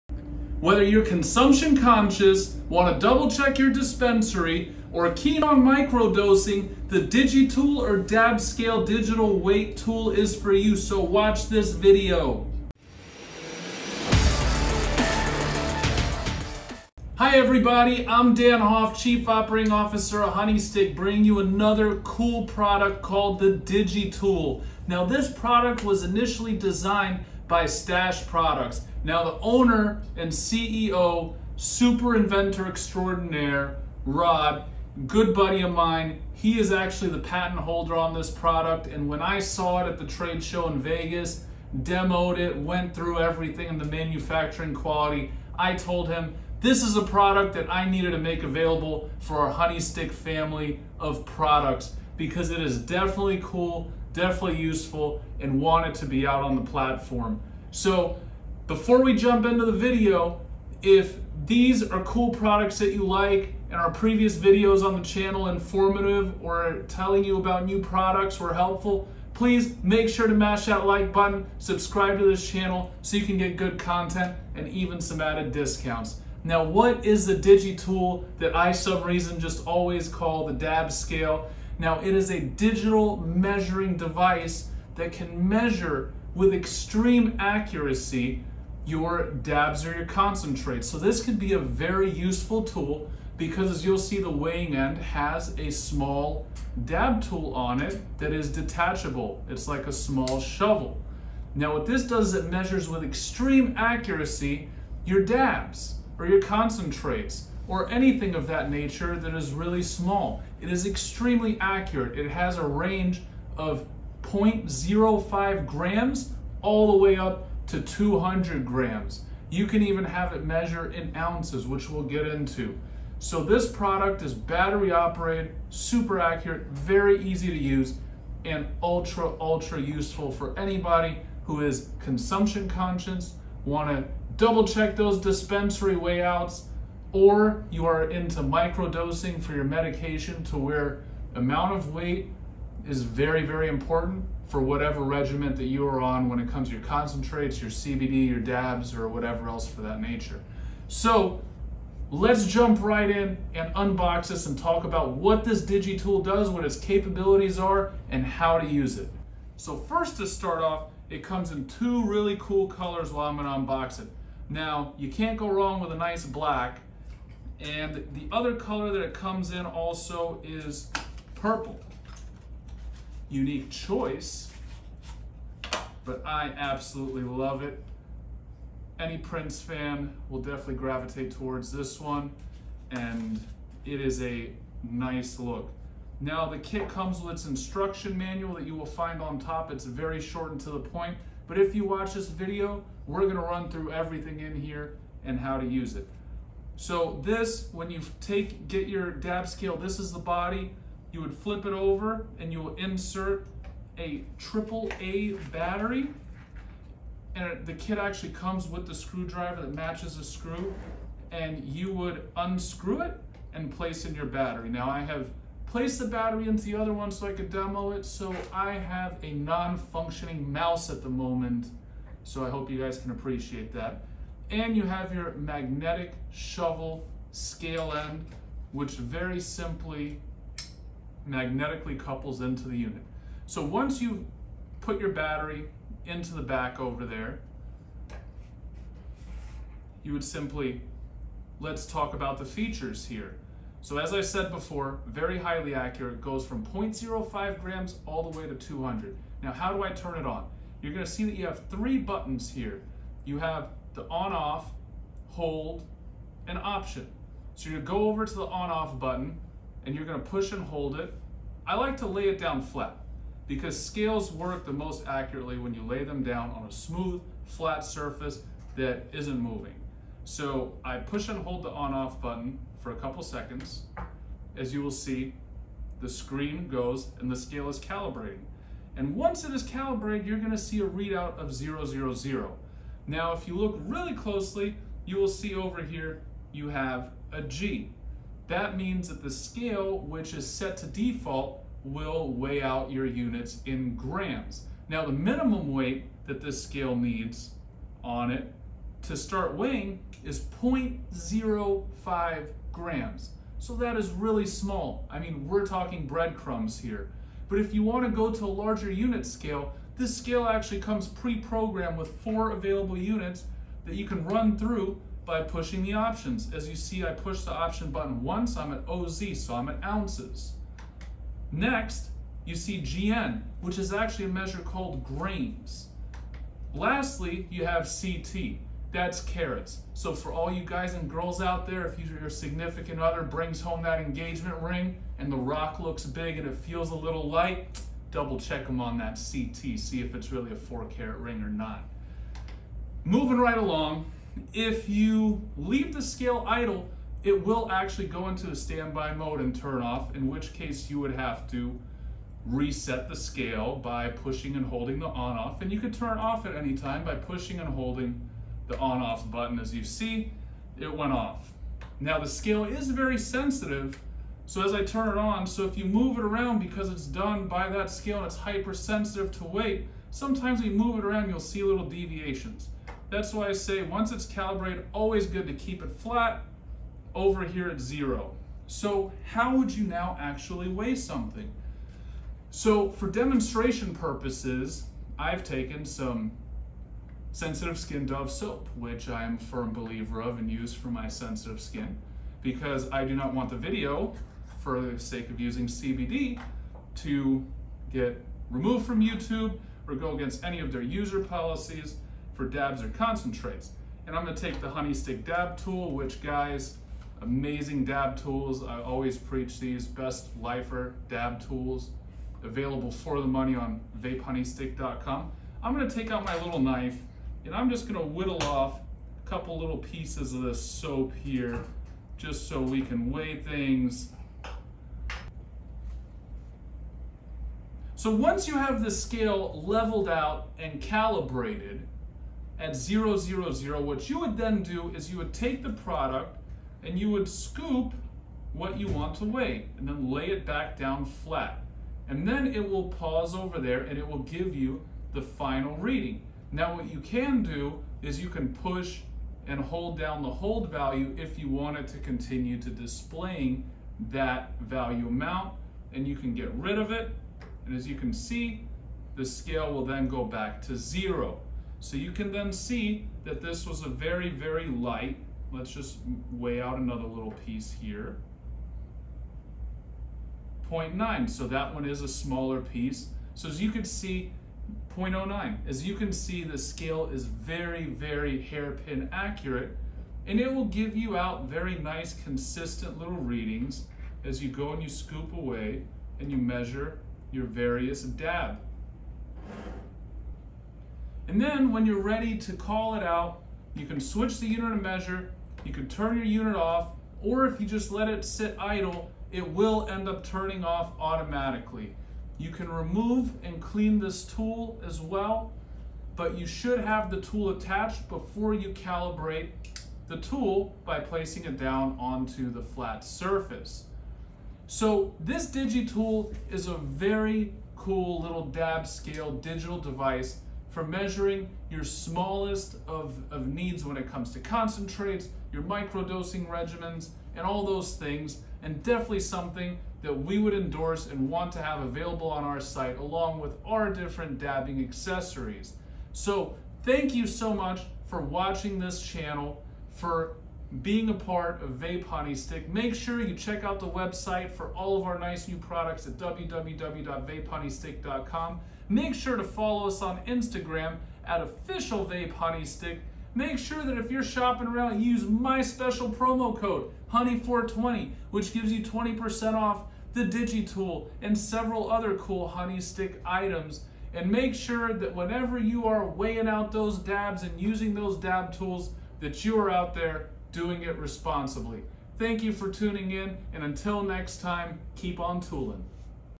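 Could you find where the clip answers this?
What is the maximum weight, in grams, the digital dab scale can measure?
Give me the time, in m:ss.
1:57.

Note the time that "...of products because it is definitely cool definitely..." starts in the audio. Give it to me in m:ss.
0:51.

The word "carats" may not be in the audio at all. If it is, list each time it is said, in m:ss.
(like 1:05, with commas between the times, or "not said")
5:29, 5:40.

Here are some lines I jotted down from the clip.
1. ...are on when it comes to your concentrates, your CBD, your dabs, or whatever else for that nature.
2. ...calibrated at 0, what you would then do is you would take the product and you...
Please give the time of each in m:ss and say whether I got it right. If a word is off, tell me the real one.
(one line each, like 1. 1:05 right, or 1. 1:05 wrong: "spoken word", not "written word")
1. 2:25 right
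2. 7:10 right.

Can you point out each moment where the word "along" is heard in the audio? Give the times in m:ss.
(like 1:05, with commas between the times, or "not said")
5:43, 8:52.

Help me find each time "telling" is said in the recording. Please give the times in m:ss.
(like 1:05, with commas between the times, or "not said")
1:06.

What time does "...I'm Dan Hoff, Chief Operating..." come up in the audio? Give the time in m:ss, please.
0:18.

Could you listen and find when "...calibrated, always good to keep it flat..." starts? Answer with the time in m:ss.
6:14.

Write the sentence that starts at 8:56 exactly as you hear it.
So thank you so much for watching this channel, for being a part of Vape Honey Stick.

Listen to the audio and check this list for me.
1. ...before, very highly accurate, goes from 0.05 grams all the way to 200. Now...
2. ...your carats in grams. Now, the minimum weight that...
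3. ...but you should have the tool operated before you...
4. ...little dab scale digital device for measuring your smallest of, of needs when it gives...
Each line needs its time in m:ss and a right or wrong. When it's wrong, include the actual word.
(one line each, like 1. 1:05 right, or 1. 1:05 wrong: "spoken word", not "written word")
1. 4:04 right
2. 4:52 wrong: "units", not "carats"
3. 8:26 wrong: "attached", not "operated"
4. 8:38 wrong: "comes", not "gives".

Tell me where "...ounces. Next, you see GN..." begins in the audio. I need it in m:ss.
5:19.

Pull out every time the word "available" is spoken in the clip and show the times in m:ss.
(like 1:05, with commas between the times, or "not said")
0:48, 5:12, 6:52, 8:51.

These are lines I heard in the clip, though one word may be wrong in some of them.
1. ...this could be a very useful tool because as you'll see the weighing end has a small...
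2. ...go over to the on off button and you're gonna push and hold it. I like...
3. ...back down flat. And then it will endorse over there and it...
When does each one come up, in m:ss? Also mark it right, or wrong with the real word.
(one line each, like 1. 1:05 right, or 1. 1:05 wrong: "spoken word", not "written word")
1. 1:30 right
2. 4:17 right
3. 7:20 wrong: "pause", not "endorse".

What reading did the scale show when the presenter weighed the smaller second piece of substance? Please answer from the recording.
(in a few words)
0.09.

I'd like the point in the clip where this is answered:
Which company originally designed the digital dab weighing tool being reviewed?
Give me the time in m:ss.
0:27.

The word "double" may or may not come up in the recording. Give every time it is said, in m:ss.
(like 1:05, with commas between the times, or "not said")
0:03, 2:14, 5:38.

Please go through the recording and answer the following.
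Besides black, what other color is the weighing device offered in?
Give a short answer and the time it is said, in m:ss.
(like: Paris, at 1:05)
Purple, at 2:51.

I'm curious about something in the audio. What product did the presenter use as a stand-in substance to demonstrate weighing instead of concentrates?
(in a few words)
Dove soap.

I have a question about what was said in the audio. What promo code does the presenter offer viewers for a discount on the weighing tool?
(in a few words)
Honey420.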